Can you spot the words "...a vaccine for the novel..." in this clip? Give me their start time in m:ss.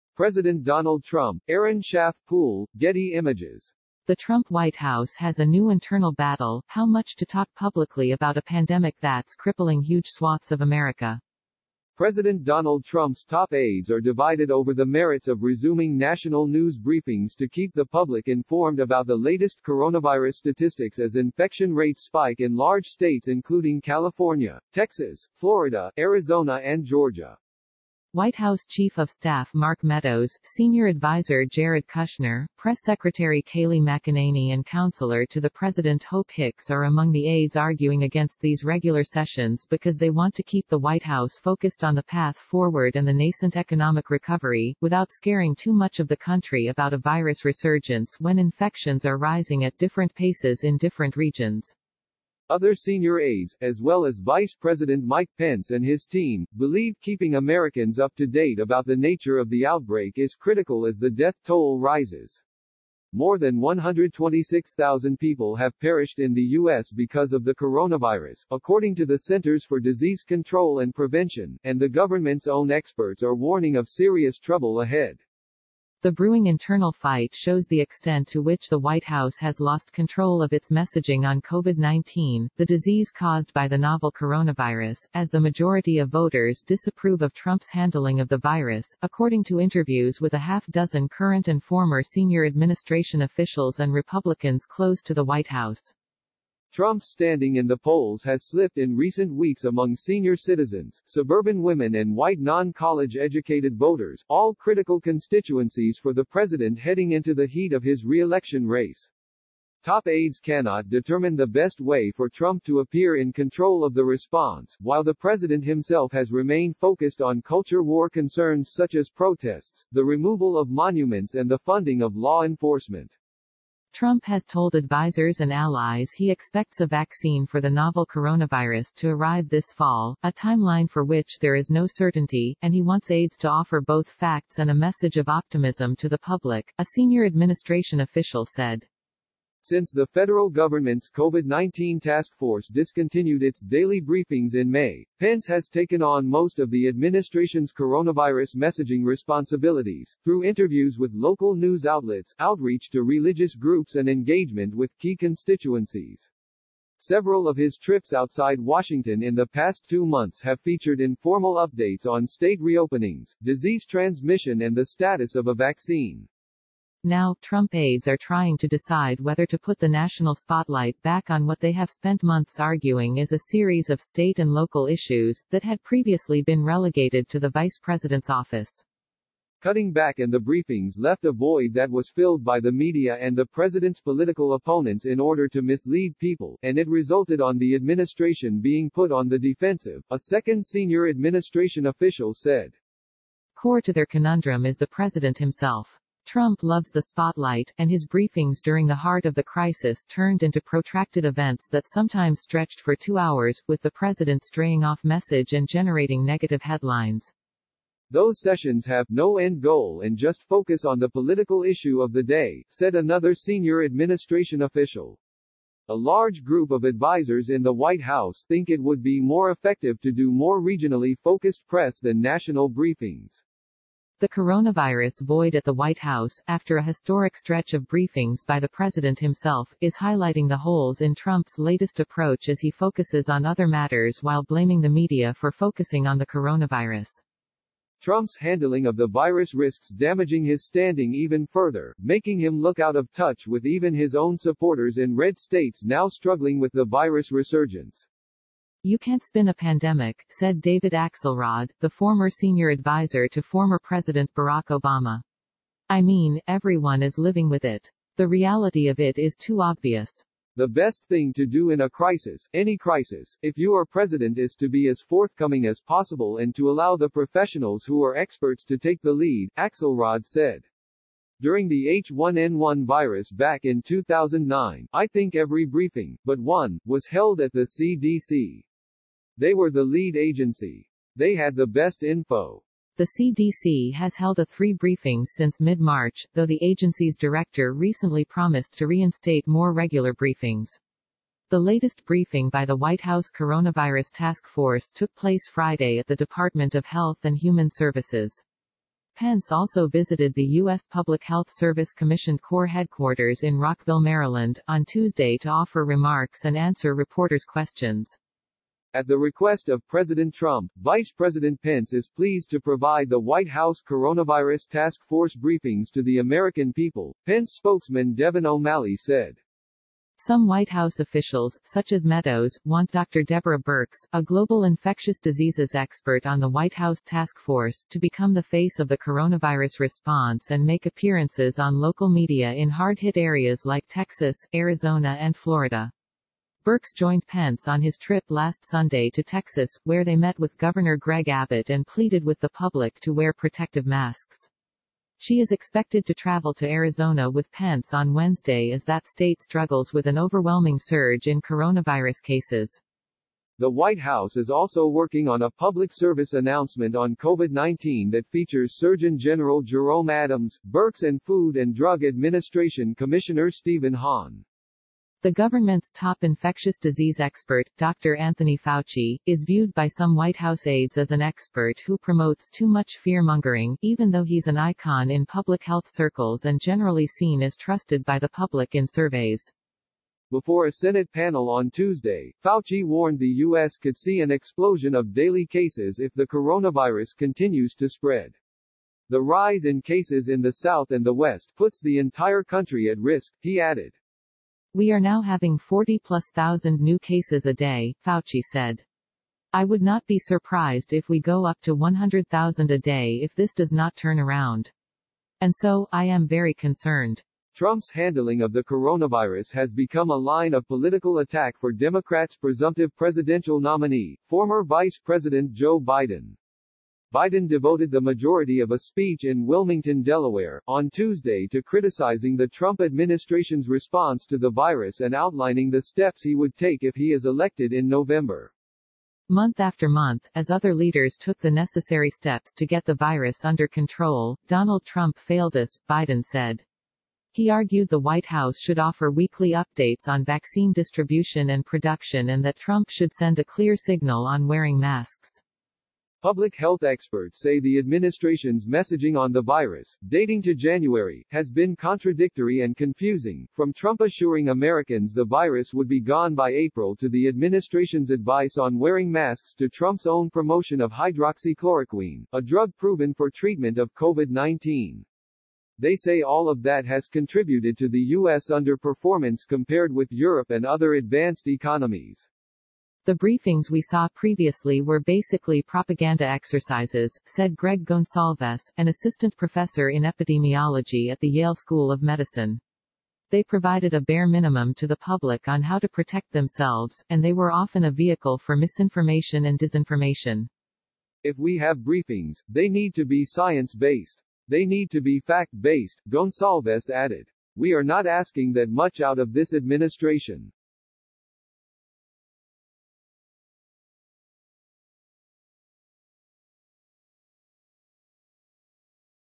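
2:06.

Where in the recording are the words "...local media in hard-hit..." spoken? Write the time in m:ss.
5:31.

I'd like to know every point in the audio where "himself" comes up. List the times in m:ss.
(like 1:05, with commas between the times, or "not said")
1:55, 3:15, 3:49.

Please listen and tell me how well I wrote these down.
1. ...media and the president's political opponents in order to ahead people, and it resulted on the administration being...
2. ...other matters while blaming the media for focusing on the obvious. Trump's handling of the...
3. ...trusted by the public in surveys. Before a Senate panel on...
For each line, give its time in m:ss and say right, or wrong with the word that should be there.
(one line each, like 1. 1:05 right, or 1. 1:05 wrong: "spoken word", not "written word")
1. 3:02 wrong: "mislead", not "ahead"
2. 3:53 wrong: "coronavirus", not "obvious"
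3. 6:17 right.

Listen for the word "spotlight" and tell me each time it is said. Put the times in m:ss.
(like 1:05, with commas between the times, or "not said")
2:50, 3:17.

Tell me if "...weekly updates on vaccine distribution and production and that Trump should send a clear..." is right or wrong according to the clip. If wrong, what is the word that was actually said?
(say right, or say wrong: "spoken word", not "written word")
right.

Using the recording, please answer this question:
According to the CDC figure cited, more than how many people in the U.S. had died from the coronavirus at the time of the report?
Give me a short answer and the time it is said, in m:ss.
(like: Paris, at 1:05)
126,000, at 1:03.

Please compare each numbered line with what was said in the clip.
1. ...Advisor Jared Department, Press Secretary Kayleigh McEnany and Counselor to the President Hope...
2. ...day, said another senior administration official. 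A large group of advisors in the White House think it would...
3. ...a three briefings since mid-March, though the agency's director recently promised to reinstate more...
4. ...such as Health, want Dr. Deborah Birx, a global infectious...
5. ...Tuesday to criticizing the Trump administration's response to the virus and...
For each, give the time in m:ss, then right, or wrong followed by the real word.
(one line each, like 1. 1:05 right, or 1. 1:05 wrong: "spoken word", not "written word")
1. 0:30 wrong: "Kushner", not "Department"
2. 3:32 right
3. 4:44 right
4. 5:21 wrong: "Meadows", not "Health"
5. 7:00 right.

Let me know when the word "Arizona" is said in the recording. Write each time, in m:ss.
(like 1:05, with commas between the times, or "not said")
0:25, 5:34, 5:46.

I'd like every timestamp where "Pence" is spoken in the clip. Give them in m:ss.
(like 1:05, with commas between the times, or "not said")
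0:55, 2:25, 4:59, 5:11, 5:17, 5:37, 5:47.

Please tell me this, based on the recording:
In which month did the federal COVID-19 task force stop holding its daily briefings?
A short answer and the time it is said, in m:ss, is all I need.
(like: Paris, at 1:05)
May, at 2:24.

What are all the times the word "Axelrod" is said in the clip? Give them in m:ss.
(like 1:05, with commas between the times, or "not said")
4:10, 4:29.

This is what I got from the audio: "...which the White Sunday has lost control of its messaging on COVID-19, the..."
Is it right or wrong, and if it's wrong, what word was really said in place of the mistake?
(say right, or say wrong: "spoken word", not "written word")
wrong: "House", not "Sunday".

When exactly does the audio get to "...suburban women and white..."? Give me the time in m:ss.
1:41.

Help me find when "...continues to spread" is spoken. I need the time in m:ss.
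6:27.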